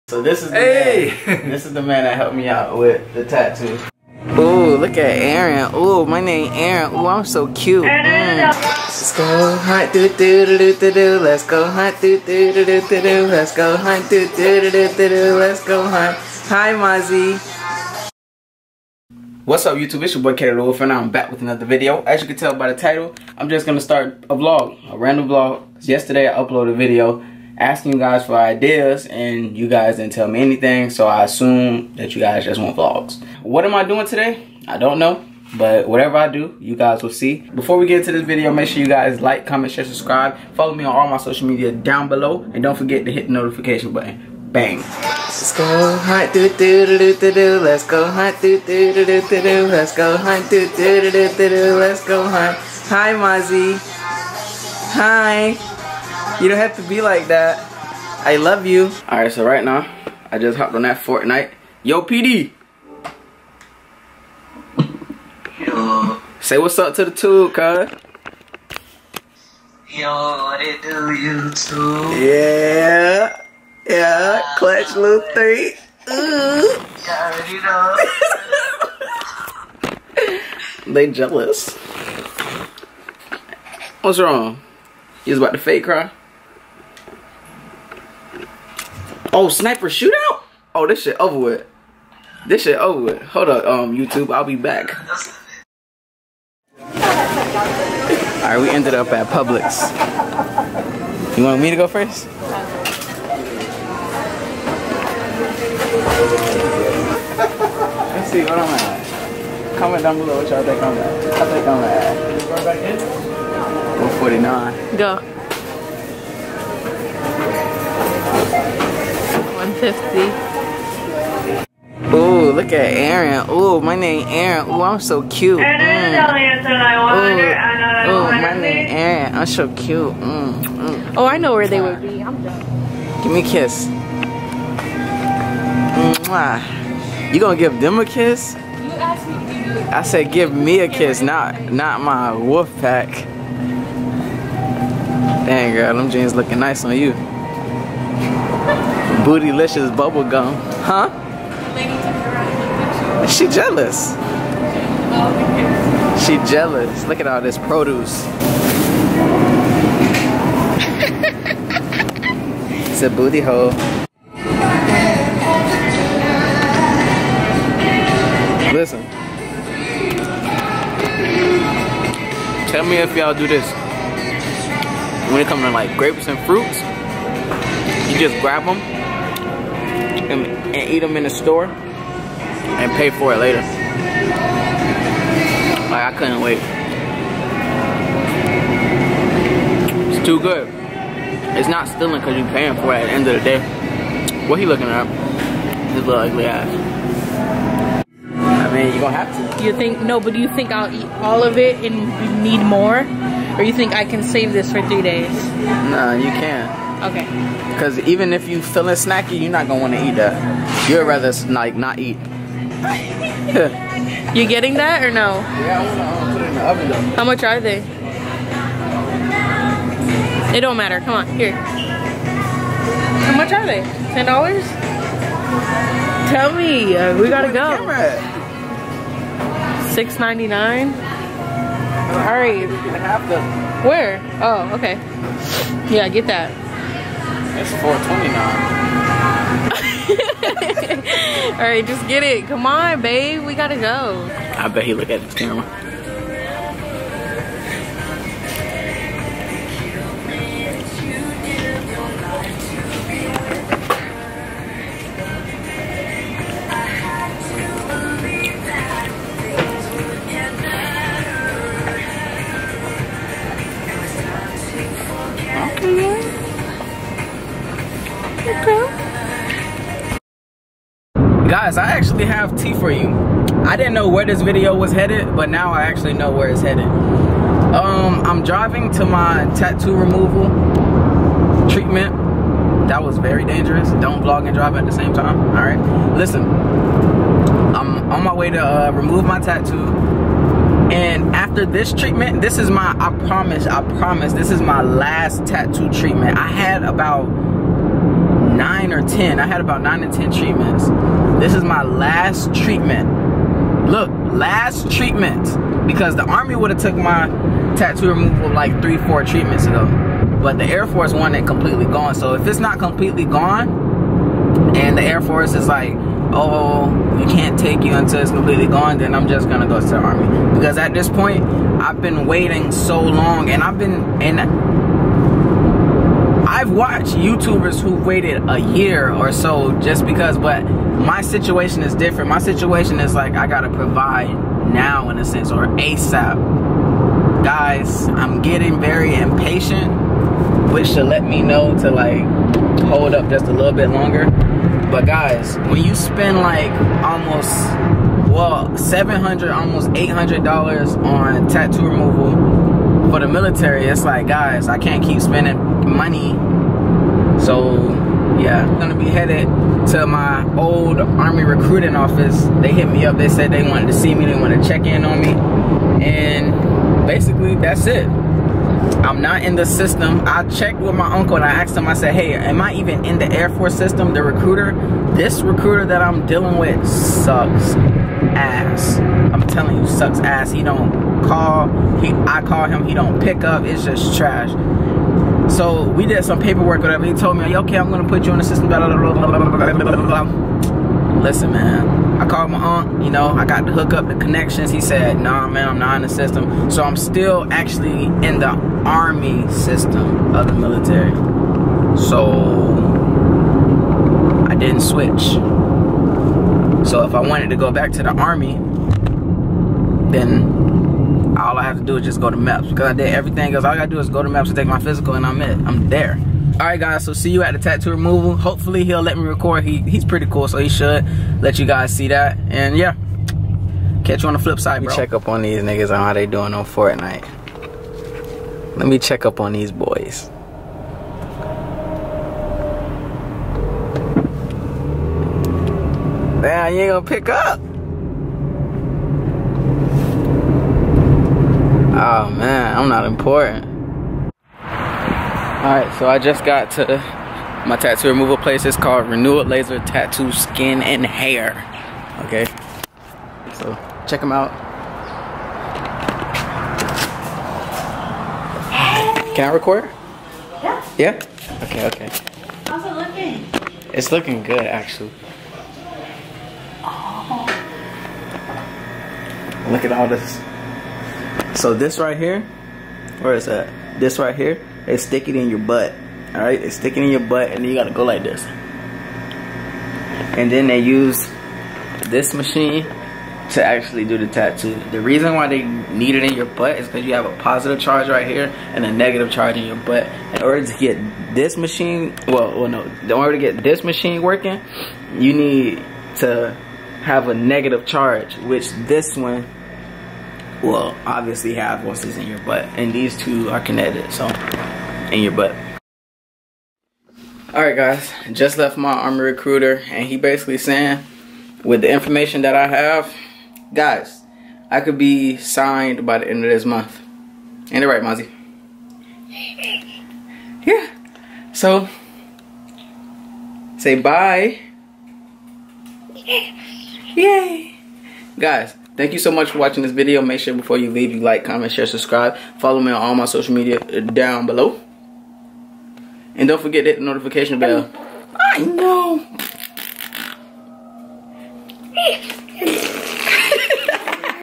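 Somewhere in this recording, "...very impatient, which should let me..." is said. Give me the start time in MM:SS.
05:38.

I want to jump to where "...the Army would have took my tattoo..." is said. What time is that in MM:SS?
05:06.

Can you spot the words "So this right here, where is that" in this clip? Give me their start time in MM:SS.
07:51.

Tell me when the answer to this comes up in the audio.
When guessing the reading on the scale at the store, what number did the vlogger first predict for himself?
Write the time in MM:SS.
01:53.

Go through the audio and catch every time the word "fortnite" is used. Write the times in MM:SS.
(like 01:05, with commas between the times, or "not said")
01:00, 07:06.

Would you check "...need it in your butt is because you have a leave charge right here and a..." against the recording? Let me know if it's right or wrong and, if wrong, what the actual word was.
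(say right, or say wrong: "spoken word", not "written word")
wrong: "positive", not "leave".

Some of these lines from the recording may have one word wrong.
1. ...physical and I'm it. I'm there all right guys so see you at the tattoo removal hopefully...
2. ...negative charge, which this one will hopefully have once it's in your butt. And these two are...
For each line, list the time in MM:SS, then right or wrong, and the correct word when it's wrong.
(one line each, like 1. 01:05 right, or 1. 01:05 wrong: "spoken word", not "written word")
1. 06:54 right
2. 08:17 wrong: "obviously", not "hopefully".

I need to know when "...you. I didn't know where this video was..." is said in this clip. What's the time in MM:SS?
04:32.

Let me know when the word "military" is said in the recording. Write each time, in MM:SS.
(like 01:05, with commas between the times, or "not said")
05:53, 06:40.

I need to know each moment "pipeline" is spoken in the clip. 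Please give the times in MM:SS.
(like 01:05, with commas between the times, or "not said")
not said.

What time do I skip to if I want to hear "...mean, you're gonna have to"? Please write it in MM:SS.
03:18.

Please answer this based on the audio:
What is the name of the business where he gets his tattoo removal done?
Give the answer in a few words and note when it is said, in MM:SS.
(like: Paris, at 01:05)
Renewal Laser Tattoo Skin and Hair, at 07:29.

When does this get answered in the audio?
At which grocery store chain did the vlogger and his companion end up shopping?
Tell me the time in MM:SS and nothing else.
01:39.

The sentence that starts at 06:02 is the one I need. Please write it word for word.
They hit me up, they said they wanted to see me, they wanted to check in on me.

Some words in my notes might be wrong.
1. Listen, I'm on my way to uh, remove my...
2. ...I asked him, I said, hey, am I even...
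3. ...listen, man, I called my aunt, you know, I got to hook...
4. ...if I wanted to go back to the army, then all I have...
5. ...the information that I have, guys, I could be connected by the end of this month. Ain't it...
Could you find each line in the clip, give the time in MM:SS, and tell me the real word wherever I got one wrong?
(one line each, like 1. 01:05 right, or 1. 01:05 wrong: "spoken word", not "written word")
1. 04:46 right
2. 06:11 right
3. 06:31 right
4. 06:47 right
5. 08:31 wrong: "signed", not "connected".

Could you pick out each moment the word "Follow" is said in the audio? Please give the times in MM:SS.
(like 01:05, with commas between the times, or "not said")
00:40, 08:52.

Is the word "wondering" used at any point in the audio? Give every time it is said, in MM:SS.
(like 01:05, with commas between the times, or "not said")
not said.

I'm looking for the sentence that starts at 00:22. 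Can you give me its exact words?
As you can tell by the title, I'm just gonna start a vlog, a random vlog.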